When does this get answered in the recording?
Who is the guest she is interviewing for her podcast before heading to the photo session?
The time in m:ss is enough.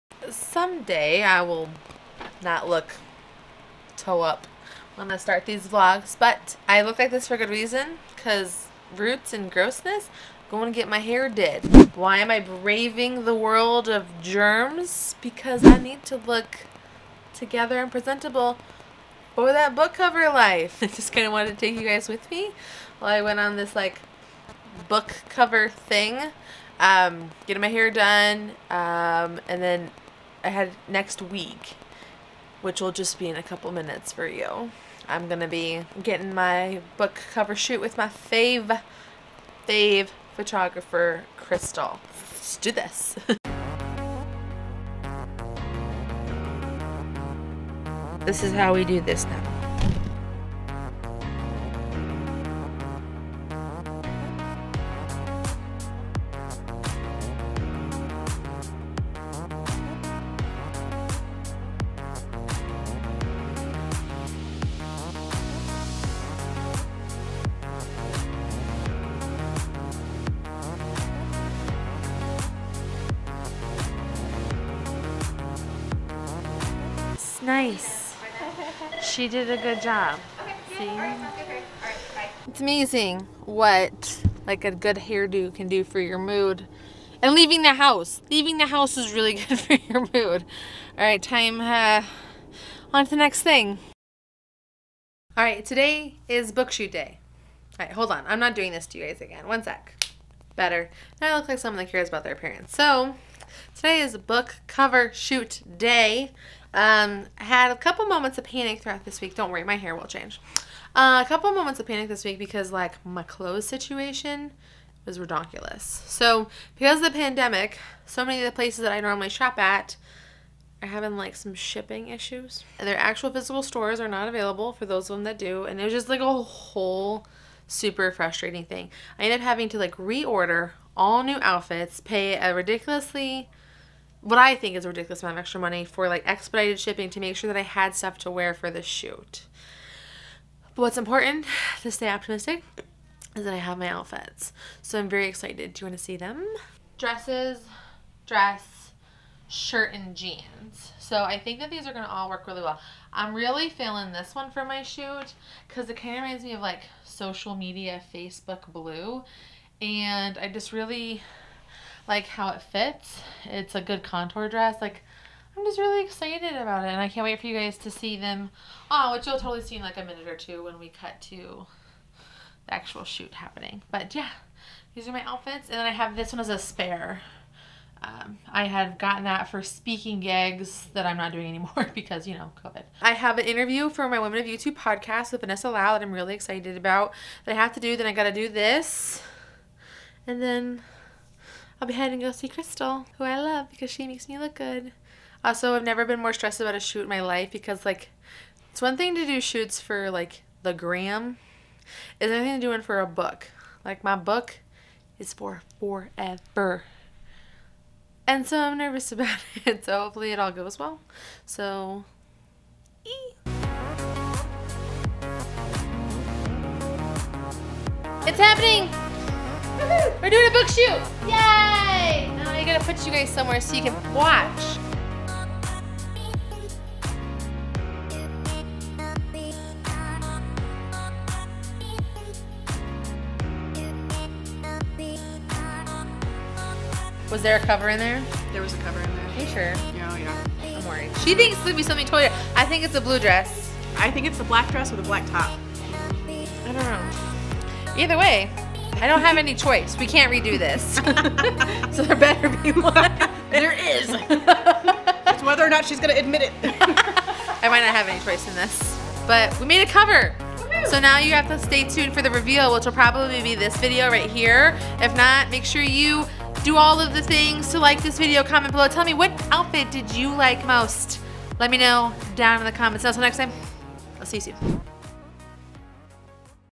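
3:05.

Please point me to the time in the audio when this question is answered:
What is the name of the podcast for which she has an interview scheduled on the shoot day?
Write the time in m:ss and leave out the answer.
3:04.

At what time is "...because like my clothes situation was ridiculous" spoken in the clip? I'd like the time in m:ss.
1:52.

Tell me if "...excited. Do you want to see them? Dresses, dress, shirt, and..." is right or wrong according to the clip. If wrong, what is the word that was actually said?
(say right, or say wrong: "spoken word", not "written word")
right.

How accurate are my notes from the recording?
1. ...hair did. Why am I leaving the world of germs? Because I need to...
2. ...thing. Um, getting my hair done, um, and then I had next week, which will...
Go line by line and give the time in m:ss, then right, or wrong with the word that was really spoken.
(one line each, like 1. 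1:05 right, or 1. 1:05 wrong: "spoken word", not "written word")
1. 0:10 wrong: "braving", not "leaving"
2. 0:25 right.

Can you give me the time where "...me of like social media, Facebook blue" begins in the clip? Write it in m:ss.
2:36.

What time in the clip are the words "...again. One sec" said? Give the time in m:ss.
1:39.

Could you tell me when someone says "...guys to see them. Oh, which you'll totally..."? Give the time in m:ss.
2:47.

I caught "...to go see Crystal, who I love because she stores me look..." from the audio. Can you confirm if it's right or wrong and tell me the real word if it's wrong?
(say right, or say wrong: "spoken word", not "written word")
wrong: "makes", not "stores".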